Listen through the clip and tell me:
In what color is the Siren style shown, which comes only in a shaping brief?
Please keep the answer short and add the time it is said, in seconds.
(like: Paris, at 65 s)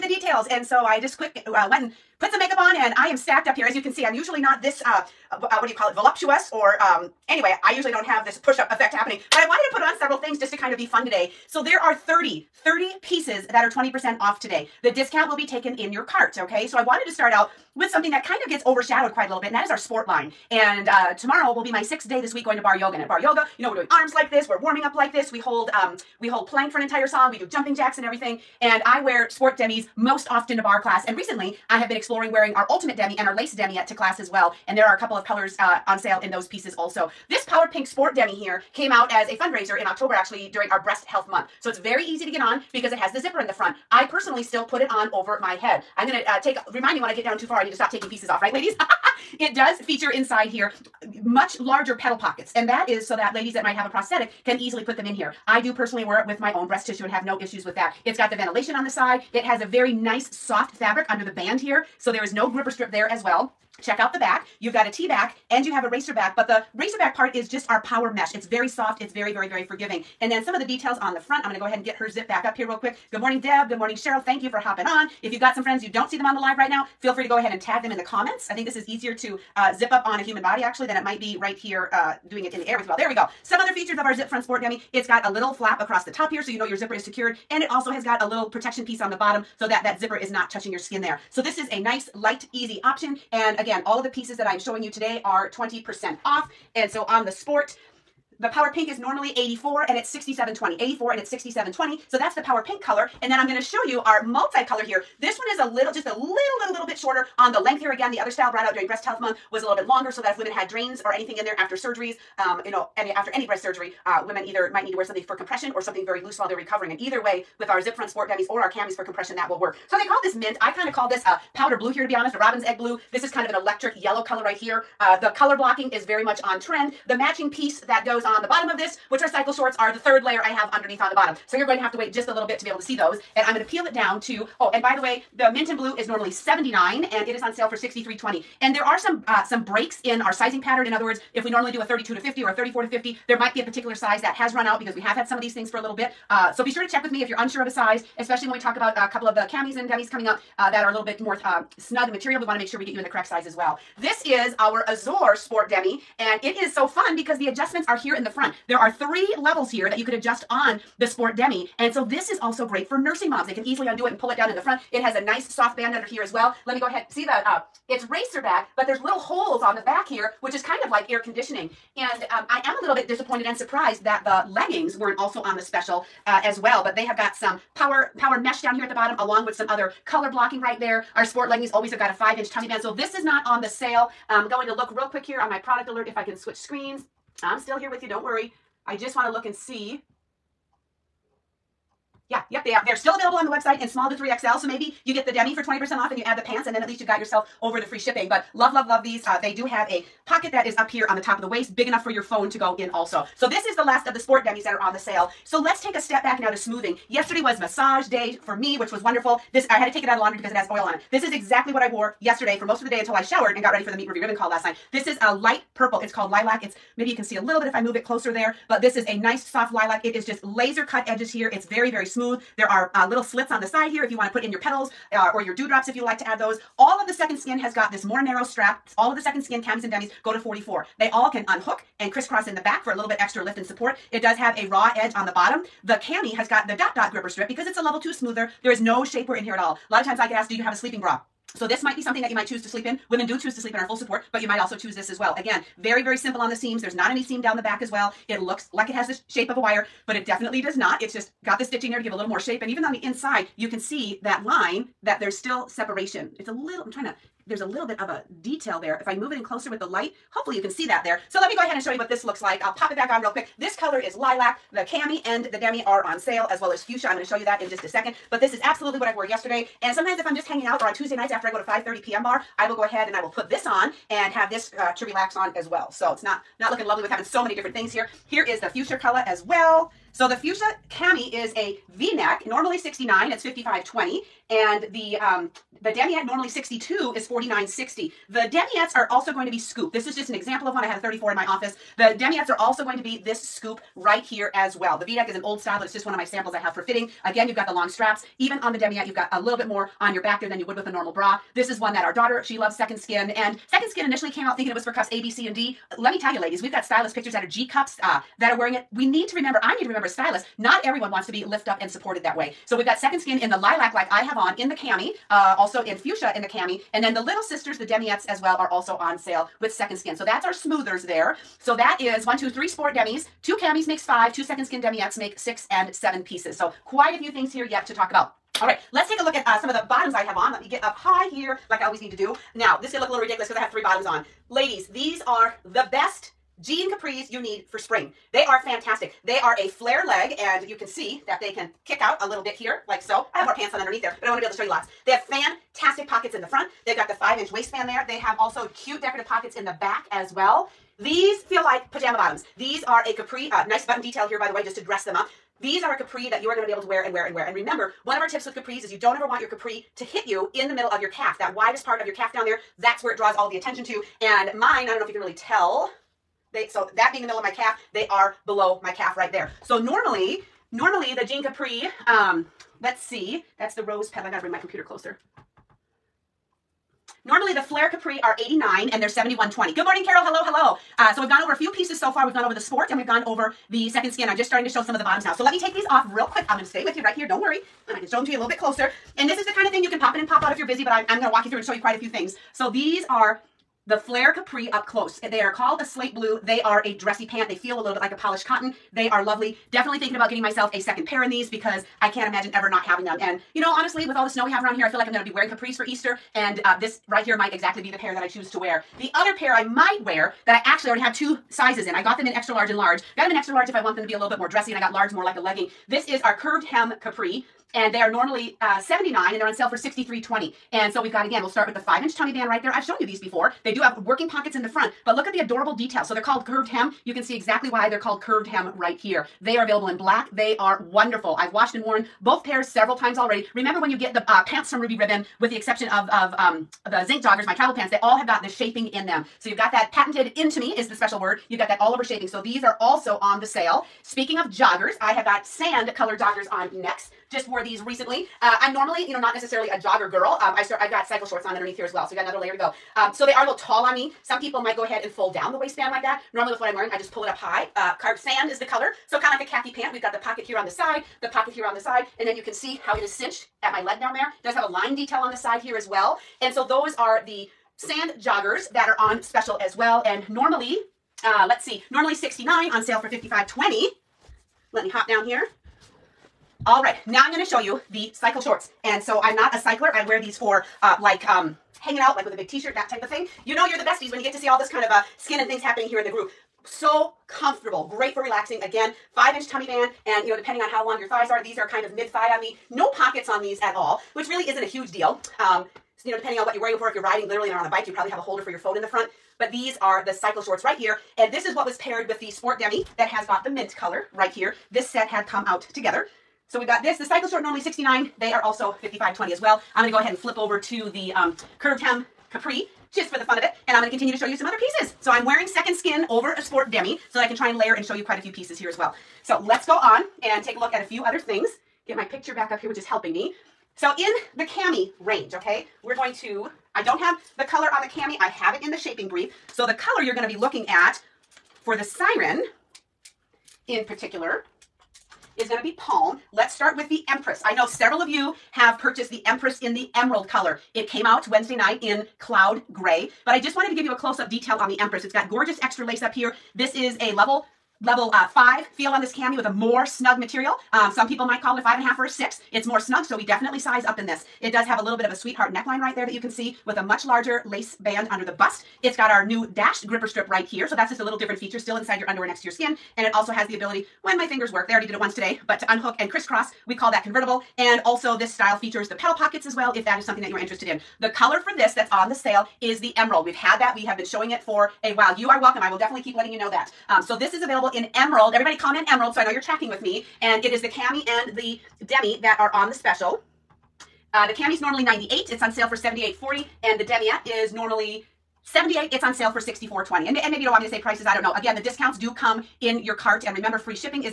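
Palm, at 535 s.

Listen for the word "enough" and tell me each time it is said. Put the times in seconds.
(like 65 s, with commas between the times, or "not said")
201 s.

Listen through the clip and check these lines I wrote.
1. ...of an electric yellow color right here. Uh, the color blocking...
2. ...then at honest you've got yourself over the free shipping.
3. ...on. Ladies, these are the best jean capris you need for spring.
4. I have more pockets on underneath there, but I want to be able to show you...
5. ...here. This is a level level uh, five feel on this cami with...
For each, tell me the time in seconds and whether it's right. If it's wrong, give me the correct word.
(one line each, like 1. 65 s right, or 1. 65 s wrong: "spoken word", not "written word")
1. 123 s right
2. 196 s wrong: "least", not "honest"
3. 334 s right
4. 343 s wrong: "pants", not "pockets"
5. 546 s right.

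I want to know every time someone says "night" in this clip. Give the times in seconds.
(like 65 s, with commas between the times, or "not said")
214 s, 271 s, 541 s.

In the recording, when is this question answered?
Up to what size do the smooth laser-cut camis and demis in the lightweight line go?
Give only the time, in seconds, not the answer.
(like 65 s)
230 s.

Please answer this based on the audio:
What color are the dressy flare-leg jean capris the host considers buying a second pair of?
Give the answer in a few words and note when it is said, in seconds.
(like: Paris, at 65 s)
Slate blue, at 395 s.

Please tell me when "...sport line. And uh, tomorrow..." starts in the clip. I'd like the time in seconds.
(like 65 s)
19 s.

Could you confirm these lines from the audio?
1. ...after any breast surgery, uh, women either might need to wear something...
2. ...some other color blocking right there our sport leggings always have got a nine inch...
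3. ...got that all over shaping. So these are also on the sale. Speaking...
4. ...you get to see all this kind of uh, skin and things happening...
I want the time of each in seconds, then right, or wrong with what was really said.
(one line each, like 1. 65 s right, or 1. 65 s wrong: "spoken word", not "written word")
1. 113 s right
2. 179 s wrong: "five", not "nine"
3. 441 s right
4. 484 s right.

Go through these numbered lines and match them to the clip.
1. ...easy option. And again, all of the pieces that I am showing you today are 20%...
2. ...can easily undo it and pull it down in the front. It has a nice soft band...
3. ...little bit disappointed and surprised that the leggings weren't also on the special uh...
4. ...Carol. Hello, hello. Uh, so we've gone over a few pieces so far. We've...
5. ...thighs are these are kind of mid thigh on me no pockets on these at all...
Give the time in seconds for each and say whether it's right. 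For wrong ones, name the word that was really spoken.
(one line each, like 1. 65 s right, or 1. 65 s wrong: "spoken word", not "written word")
1. 92 s right
2. 163 s right
3. 172 s right
4. 380 s right
5. 491 s right.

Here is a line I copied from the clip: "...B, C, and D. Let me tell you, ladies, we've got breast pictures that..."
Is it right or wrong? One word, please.
wrong.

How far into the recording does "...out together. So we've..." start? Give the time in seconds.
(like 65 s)
505 s.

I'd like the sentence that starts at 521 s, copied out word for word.
Get my picture back up here, which is helping me.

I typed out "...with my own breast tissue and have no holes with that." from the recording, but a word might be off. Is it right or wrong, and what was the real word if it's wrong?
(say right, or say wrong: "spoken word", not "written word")
wrong: "issues", not "holes".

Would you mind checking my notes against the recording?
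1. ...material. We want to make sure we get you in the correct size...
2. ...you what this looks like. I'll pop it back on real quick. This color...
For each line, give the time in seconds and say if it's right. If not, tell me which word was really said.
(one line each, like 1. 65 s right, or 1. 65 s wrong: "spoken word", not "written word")
1. 152 s right
2. 261 s right.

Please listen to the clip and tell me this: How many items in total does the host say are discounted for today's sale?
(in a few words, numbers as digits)
30.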